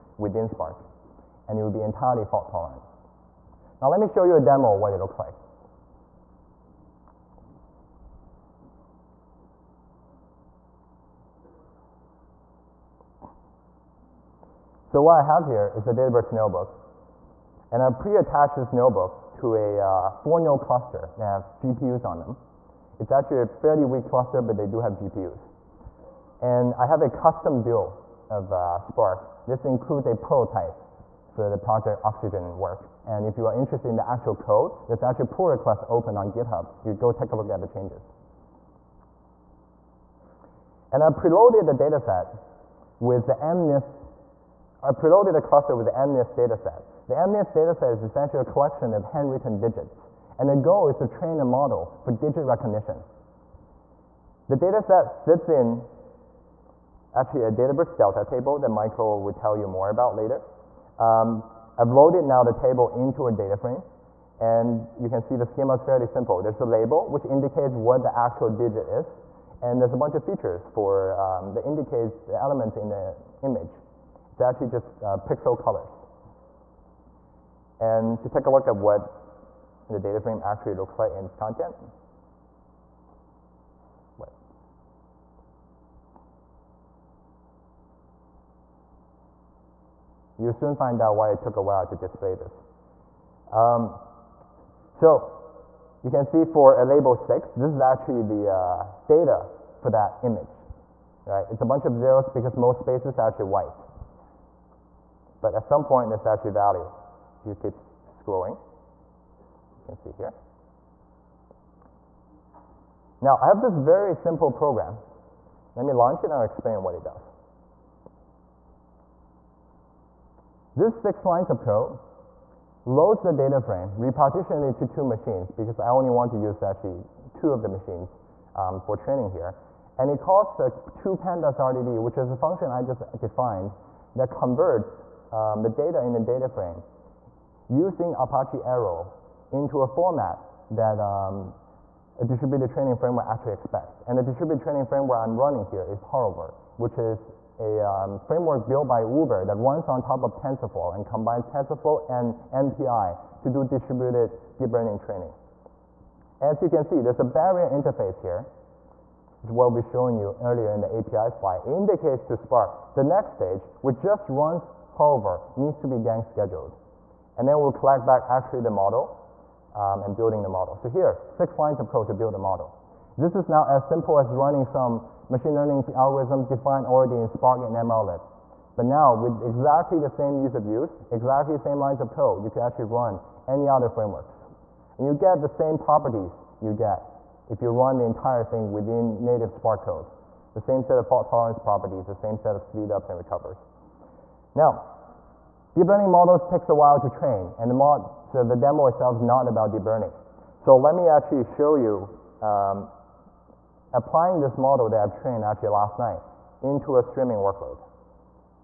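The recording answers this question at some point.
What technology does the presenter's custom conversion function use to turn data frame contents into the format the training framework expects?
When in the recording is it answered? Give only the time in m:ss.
2:18.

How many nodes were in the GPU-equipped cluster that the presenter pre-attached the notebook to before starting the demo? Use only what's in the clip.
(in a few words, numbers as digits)
4.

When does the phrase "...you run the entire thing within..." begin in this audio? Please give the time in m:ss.
3:07.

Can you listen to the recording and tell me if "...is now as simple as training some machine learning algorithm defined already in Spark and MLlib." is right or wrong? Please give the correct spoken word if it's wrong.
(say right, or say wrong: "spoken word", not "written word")
wrong: "running", not "training".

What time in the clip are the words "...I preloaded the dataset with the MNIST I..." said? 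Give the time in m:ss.
0:41.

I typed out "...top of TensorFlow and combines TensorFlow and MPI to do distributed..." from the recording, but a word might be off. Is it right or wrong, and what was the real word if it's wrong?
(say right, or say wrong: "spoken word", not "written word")
right.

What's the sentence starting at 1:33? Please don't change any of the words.
Um, so you can see for a label 6, this is actually the uh, data for that image.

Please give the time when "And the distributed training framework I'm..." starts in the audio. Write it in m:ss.
2:24.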